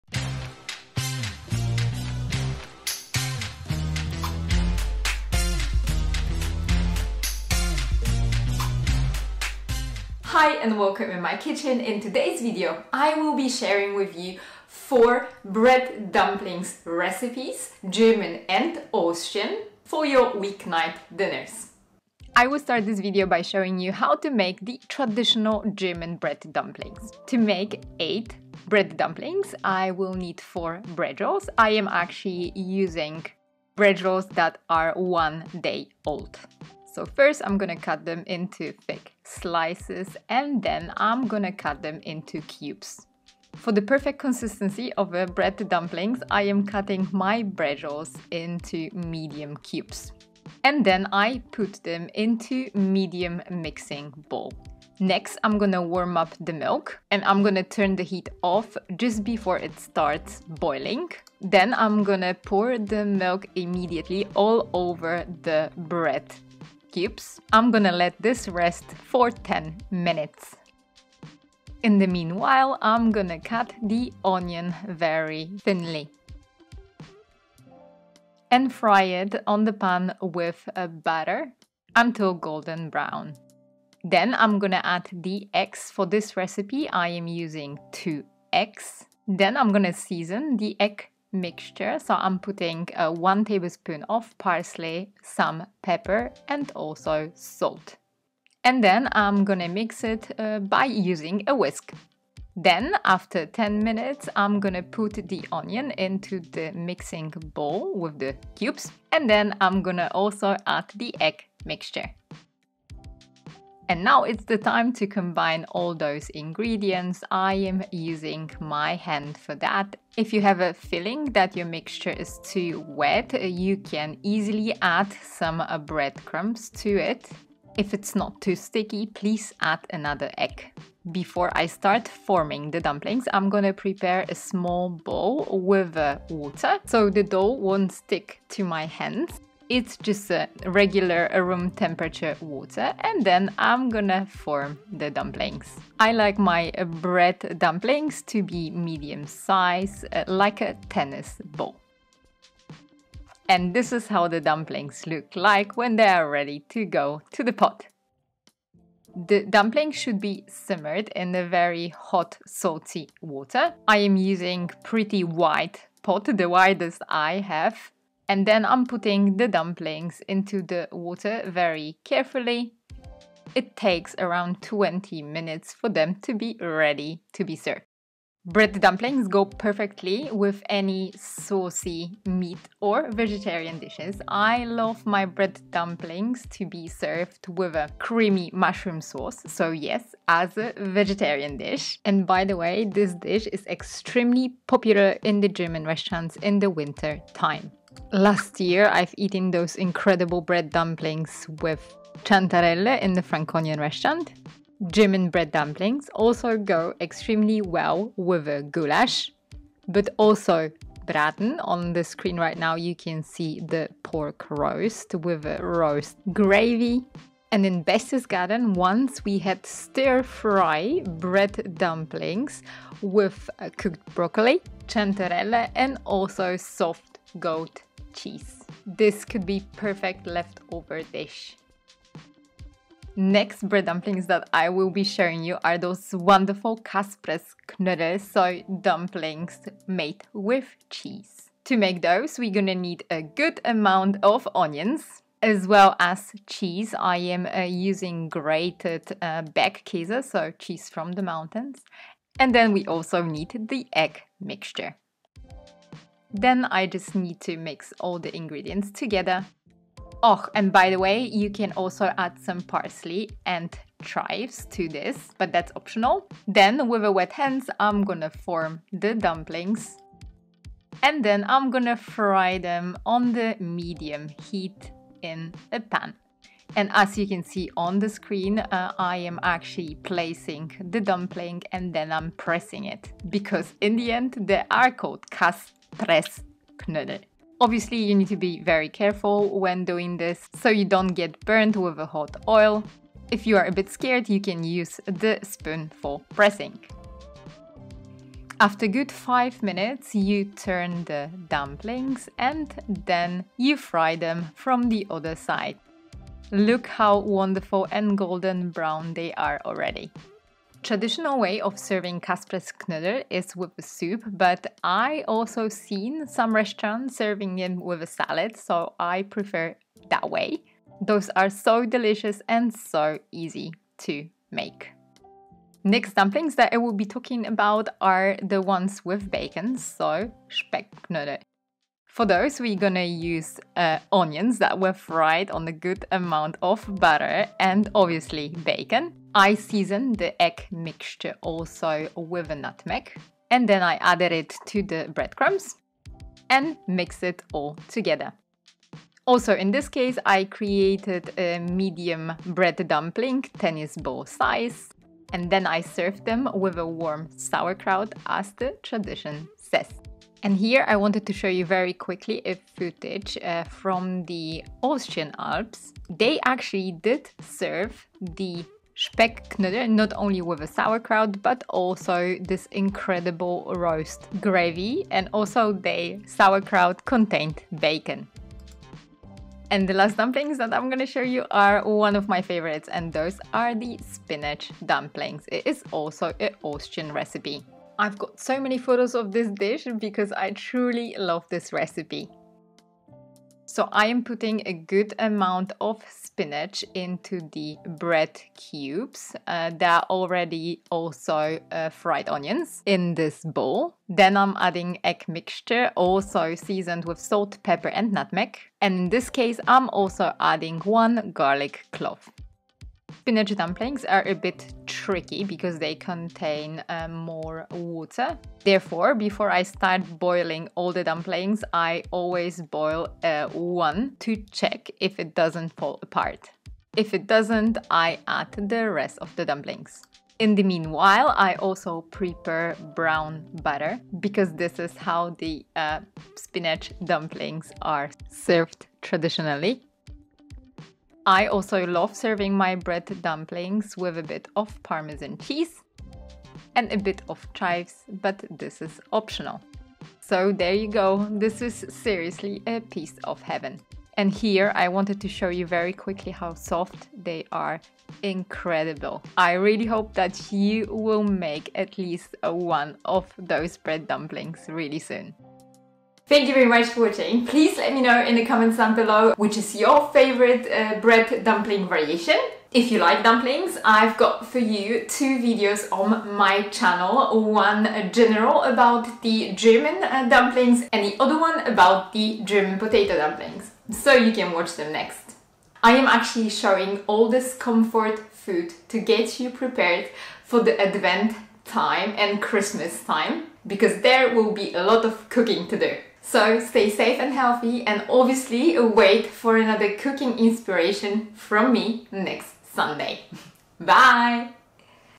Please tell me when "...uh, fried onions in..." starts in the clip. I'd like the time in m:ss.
6:41.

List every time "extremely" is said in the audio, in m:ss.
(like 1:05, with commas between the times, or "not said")
3:13, 3:26.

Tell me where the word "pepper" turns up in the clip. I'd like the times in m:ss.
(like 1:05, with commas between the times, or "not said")
1:35, 6:47.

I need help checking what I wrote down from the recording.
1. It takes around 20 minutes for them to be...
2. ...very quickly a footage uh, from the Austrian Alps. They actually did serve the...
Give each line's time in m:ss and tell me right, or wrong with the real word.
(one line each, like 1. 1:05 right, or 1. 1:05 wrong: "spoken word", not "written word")
1. 2:53 right
2. 6:01 right.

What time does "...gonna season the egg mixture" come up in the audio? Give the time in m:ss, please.
1:29.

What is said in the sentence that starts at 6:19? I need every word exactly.
And the last dumplings that I'm gonna show you are one of my favorites and those are the spinach dumplings.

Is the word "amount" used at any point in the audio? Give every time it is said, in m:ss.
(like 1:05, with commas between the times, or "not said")
4:03, 5:36, 6:35.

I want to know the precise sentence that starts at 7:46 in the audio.
Thank you very much for watching.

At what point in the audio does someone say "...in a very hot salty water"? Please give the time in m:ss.
2:41.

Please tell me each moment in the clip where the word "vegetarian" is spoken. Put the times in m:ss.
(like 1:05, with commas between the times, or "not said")
3:03, 3:10.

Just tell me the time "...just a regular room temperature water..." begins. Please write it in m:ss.
2:19.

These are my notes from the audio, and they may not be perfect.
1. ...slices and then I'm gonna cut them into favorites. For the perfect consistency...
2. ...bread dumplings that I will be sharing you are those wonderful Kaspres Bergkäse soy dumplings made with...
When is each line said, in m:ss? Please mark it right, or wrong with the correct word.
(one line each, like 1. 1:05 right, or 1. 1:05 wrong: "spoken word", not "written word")
1. 0:39 wrong: "cubes", not "favorites"
2. 3:53 wrong: "Knödel", not "Bergkäse".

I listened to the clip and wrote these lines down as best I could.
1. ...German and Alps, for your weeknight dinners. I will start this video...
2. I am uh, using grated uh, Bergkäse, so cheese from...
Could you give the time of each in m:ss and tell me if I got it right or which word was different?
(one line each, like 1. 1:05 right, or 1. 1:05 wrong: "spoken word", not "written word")
1. 0:17 wrong: "Austrian", not "Alps"
2. 4:06 right.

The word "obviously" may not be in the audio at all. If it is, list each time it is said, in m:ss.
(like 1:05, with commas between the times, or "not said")
4:47, 5:37, 8:18.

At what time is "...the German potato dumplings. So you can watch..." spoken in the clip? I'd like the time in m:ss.
8:02.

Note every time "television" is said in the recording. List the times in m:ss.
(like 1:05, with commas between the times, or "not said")
not said.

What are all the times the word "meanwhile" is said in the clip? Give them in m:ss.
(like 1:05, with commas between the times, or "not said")
1:12, 7:10.